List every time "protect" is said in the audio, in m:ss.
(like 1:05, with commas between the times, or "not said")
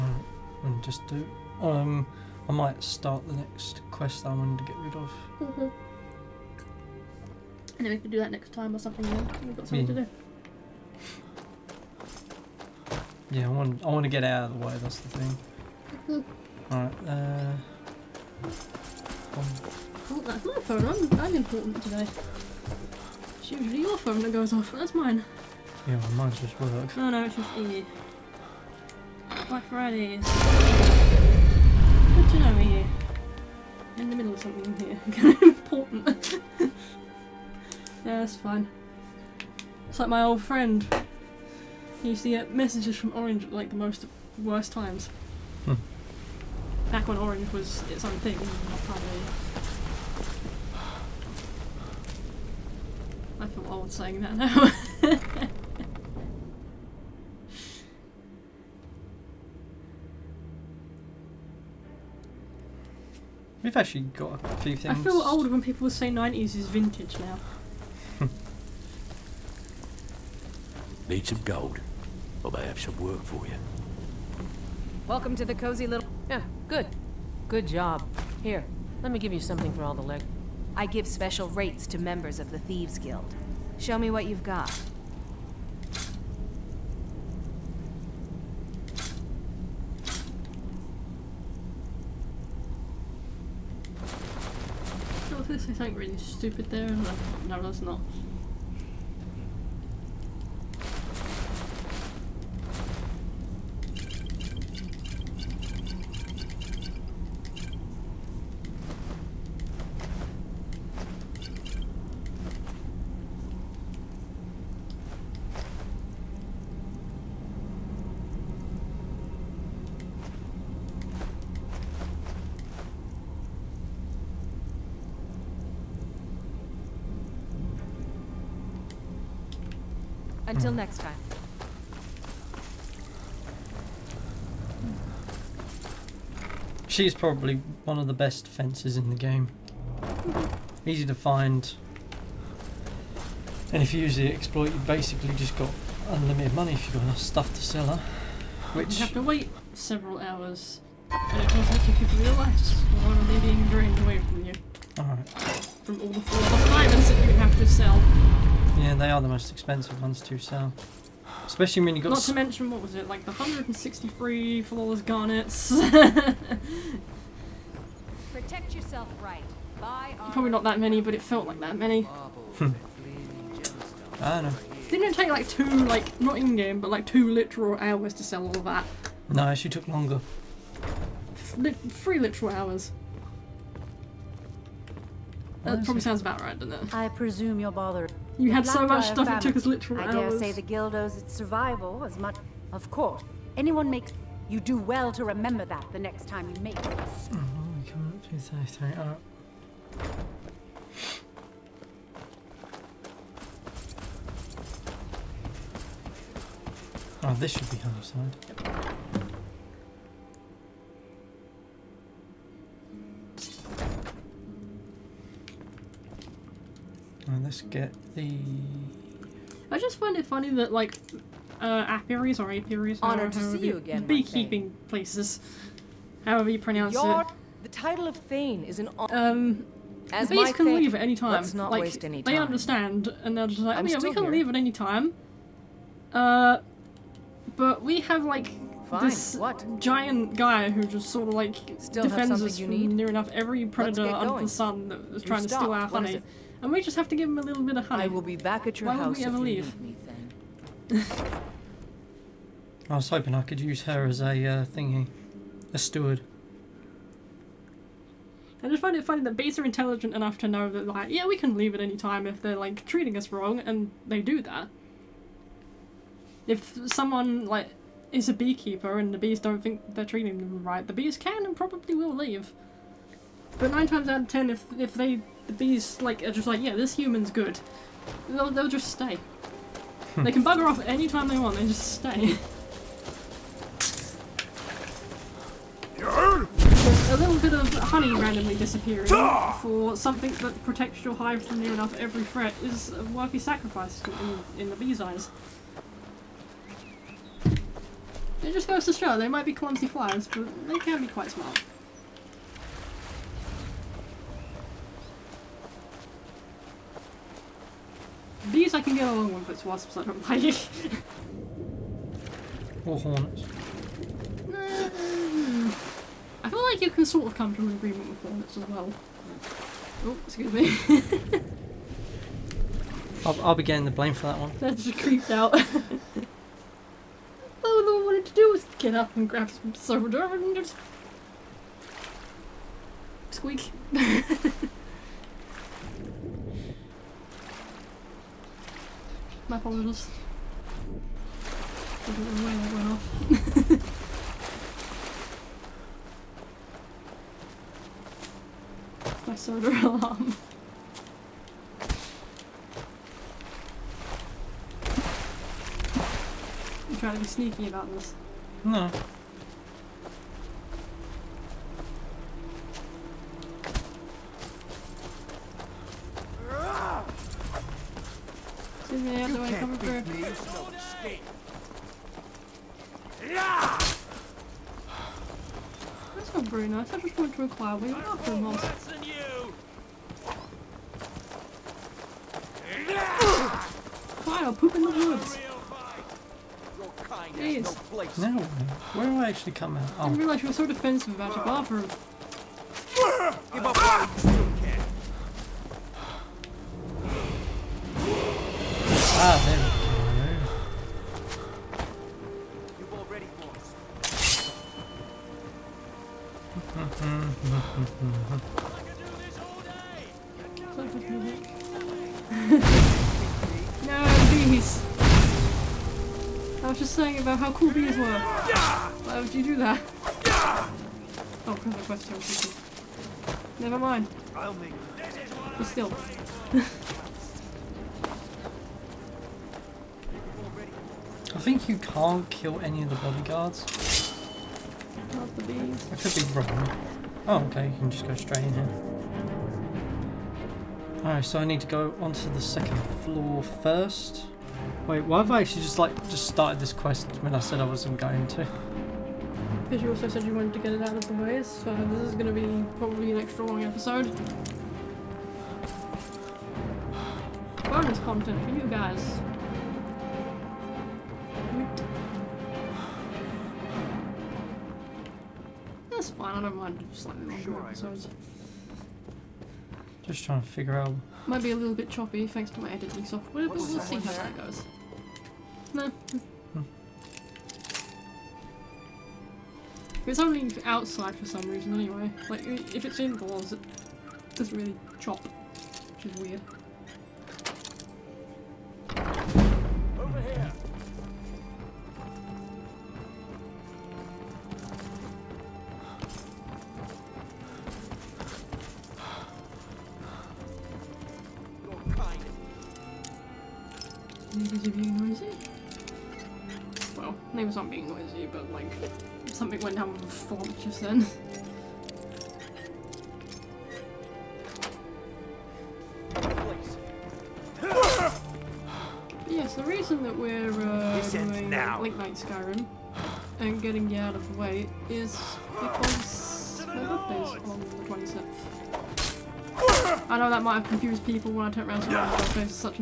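2:48, 4:50.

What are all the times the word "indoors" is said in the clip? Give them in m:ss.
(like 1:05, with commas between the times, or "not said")
8:02.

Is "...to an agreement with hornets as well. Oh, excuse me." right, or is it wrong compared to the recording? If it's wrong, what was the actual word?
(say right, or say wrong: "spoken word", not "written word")
right.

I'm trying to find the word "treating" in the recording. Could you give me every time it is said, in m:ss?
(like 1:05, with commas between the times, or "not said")
4:22, 4:30.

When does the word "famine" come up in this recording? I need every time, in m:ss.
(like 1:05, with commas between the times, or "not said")
3:09.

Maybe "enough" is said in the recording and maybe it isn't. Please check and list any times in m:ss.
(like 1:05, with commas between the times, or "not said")
2:27, 4:03, 4:20, 4:51.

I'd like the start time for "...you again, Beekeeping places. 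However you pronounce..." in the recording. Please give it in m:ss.
3:43.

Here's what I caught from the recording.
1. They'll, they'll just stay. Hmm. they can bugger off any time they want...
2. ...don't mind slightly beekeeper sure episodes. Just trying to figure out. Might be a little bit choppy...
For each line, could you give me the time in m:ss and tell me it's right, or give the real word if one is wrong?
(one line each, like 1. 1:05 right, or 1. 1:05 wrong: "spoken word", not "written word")
1. 4:38 right
2. 7:46 wrong: "longer", not "beekeeper".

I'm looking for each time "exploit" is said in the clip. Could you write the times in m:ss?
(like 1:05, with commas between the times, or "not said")
2:24.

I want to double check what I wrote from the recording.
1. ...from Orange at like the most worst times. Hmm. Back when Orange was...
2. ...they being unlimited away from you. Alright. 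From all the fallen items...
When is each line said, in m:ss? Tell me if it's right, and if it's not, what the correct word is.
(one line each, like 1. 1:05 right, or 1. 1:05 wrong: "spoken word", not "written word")
1. 0:42 right
2. 2:33 wrong: "drained", not "unlimited".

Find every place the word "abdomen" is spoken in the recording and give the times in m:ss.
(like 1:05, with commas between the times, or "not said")
not said.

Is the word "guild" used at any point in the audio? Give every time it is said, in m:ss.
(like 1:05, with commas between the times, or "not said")
1:22, 3:10.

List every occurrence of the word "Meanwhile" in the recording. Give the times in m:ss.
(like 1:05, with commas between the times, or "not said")
not said.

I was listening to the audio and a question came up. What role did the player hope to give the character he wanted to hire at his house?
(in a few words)
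Steward.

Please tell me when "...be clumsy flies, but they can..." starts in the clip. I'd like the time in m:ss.
4:59.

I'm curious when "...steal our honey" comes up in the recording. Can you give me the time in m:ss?
4:05.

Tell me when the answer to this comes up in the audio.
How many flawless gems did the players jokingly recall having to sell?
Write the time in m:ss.
2:43.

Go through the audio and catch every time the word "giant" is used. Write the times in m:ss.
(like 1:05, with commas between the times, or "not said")
3:59.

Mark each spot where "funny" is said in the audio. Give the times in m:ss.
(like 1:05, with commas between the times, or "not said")
3:40, 4:19.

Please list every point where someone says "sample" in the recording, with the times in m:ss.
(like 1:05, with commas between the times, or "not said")
not said.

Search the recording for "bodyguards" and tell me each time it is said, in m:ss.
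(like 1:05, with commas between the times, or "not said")
7:12.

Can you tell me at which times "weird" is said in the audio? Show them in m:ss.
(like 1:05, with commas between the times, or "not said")
8:06.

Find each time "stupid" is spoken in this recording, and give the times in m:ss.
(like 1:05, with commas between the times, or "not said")
1:36.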